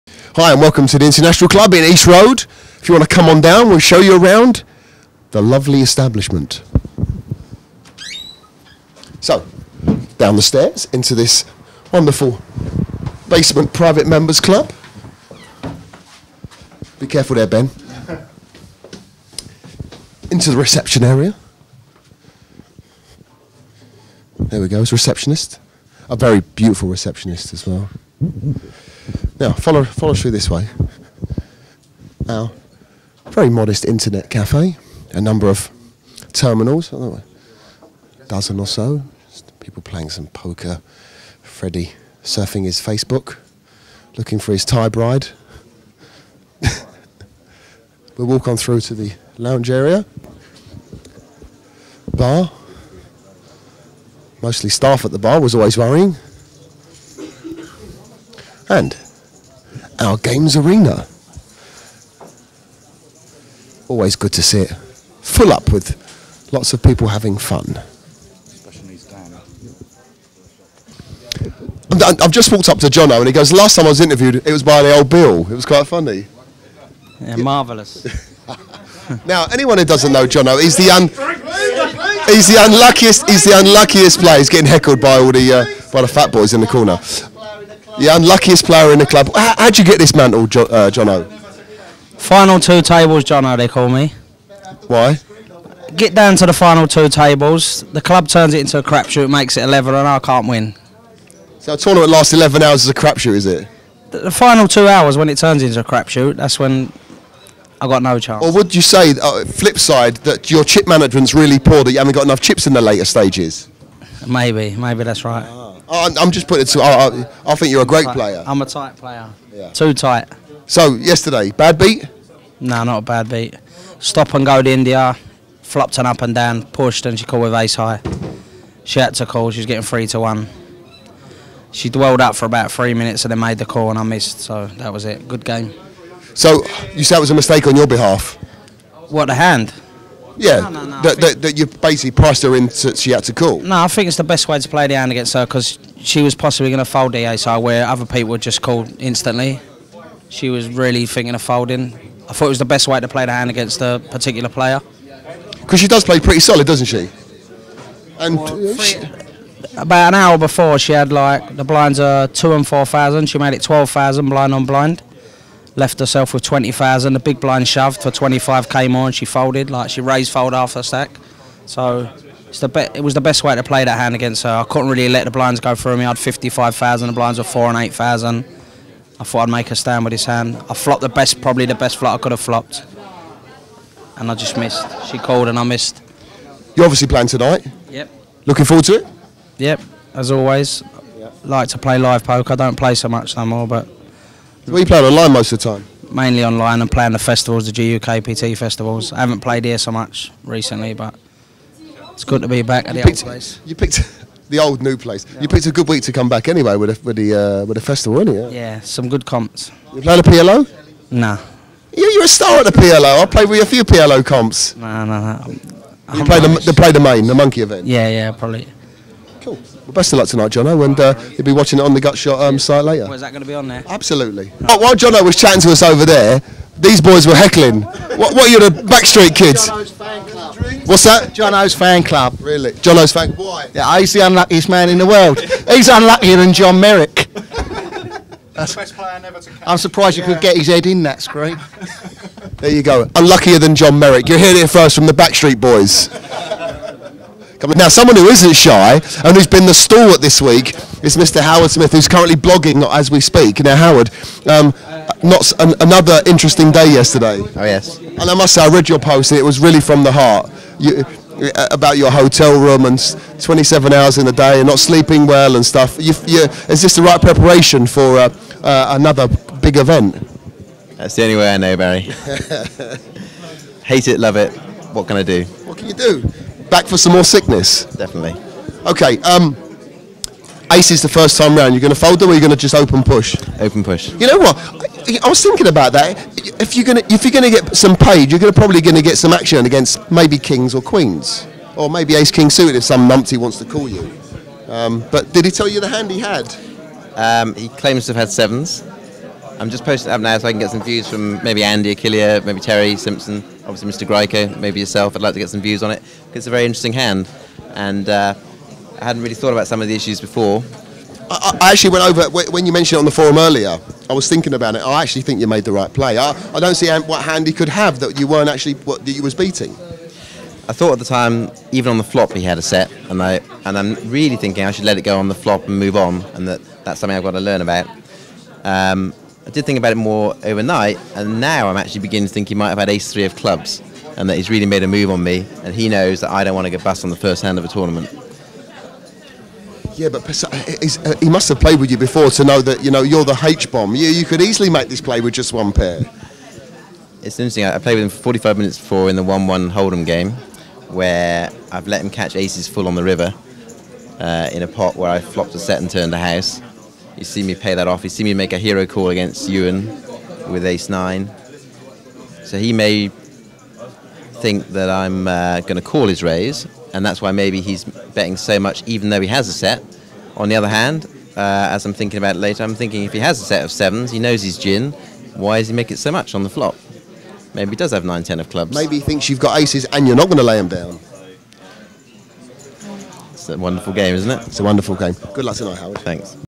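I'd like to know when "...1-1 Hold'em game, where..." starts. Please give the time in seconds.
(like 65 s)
349 s.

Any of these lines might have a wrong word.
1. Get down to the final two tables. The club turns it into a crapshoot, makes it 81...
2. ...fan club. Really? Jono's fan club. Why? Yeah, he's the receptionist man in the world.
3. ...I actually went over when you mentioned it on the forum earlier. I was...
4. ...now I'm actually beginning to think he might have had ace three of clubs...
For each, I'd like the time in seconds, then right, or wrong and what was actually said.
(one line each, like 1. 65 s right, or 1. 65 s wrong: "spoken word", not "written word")
1. 95 s wrong: "11", not "81"
2. 231 s wrong: "unluckiest", not "receptionist"
3. 311 s right
4. 331 s right.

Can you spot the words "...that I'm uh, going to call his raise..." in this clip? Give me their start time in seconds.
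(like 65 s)
364 s.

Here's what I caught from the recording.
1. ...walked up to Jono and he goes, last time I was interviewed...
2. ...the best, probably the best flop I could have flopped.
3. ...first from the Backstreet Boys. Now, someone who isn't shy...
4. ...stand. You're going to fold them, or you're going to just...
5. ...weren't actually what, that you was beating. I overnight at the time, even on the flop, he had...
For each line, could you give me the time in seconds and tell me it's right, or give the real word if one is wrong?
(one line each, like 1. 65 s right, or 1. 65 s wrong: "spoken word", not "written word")
1. 72 s right
2. 181 s right
3. 244 s right
4. 281 s wrong: "round", not "stand"
5. 318 s wrong: "thought", not "overnight".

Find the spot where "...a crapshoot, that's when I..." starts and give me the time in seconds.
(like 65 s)
105 s.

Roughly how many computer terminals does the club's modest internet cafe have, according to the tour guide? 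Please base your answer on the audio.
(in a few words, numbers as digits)
a dozen.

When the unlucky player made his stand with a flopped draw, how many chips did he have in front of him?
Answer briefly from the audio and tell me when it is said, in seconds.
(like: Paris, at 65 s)
55,000, at 176 s.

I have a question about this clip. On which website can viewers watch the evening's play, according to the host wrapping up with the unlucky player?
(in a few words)
Gutshot.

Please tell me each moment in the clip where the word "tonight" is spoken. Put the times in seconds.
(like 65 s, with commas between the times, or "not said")
187 s, 220 s, 385 s.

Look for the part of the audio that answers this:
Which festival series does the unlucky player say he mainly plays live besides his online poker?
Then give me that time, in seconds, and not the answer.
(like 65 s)
197 s.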